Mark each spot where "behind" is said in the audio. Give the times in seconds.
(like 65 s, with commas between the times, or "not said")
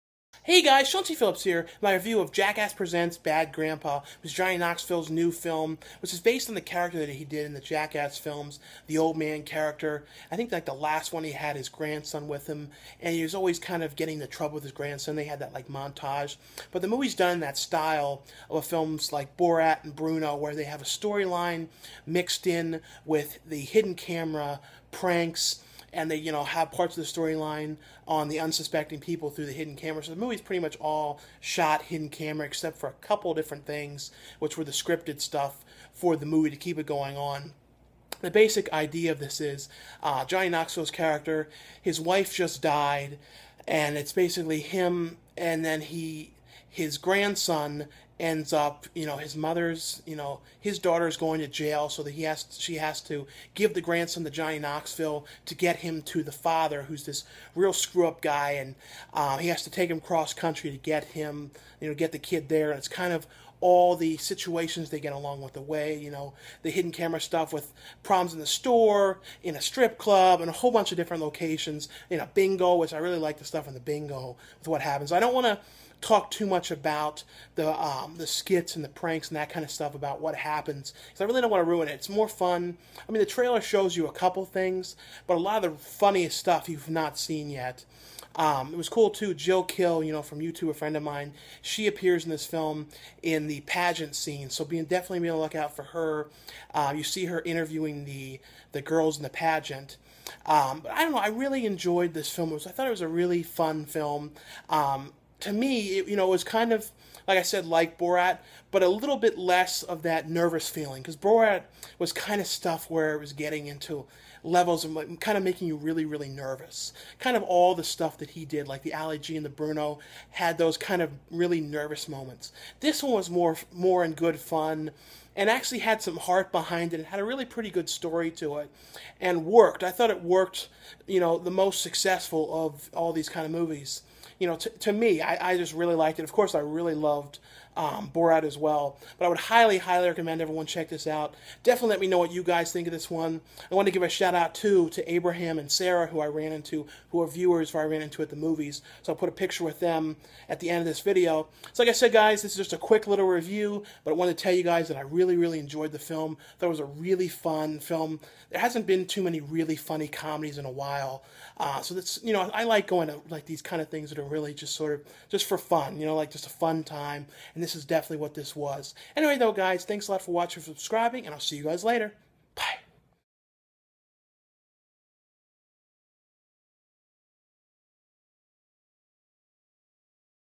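126 s.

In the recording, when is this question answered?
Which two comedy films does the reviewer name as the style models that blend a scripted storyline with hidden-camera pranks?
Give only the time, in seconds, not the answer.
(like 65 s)
19 s.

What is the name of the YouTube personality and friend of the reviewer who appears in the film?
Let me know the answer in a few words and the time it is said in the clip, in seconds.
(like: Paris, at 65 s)
Jill Kill, at 89 s.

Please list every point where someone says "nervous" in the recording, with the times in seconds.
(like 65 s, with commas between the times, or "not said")
110 s, 116 s, 121 s.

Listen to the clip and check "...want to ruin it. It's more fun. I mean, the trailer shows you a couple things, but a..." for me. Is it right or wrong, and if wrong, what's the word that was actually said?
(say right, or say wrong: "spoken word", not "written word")
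right.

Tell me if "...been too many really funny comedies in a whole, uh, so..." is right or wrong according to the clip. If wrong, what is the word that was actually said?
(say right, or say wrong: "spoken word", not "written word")
wrong: "while", not "whole".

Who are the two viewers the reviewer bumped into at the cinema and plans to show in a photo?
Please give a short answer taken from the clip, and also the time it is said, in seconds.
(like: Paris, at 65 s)
Abraham and Sarah, at 145 s.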